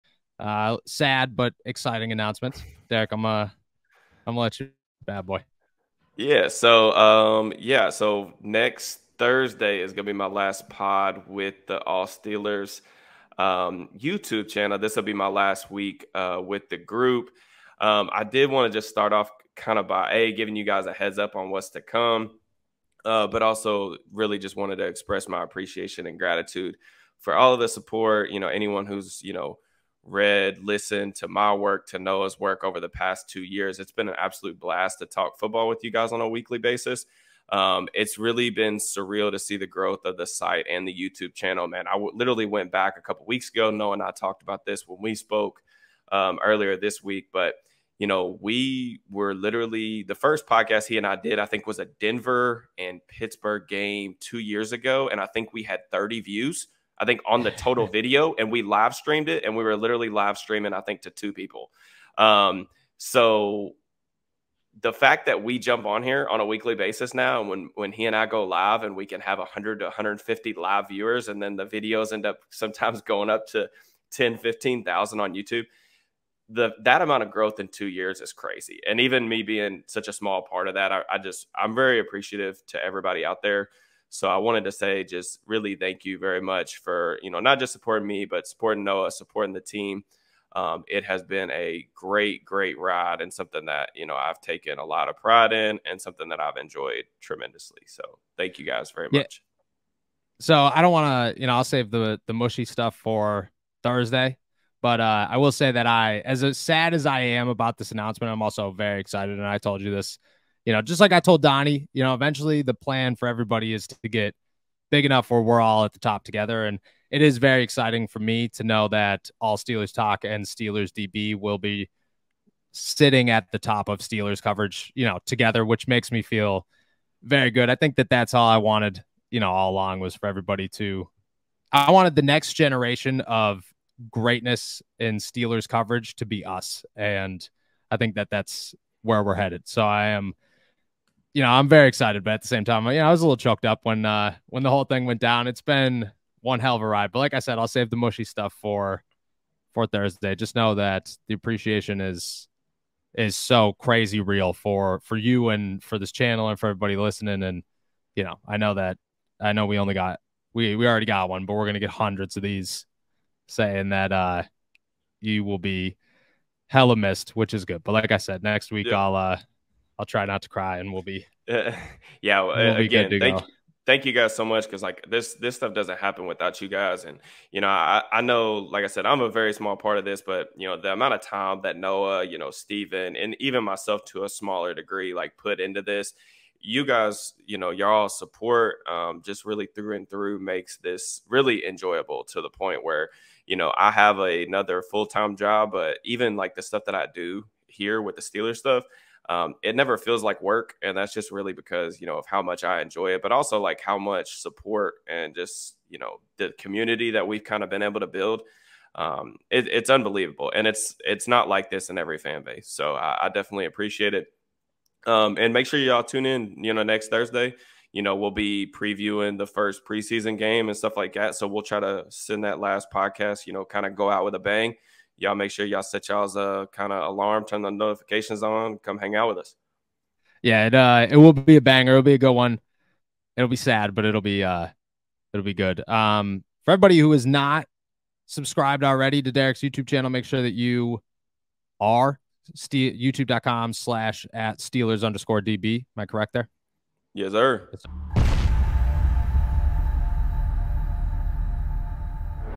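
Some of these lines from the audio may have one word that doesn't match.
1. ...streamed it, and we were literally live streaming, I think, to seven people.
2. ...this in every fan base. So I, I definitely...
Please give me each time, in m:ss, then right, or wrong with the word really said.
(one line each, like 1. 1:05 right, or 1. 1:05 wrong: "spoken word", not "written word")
1. 0:58 wrong: "two", not "seven"
2. 3:31 right.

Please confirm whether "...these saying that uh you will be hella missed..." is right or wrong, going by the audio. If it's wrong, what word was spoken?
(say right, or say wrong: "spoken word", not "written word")
right.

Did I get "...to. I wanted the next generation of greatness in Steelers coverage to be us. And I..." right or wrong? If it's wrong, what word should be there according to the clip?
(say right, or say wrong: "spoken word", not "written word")
right.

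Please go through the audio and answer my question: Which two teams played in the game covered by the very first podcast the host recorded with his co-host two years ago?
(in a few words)
Denver and Pittsburgh.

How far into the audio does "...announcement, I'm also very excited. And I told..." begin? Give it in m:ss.
1:47.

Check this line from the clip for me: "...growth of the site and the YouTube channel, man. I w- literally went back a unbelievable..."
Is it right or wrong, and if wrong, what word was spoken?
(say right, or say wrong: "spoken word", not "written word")
wrong: "couple", not "unbelievable".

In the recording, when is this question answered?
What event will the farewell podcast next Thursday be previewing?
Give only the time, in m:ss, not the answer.
3:39.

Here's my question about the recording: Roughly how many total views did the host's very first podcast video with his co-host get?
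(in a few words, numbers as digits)
30.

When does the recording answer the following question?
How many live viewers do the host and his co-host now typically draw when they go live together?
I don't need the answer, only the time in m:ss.
1:09.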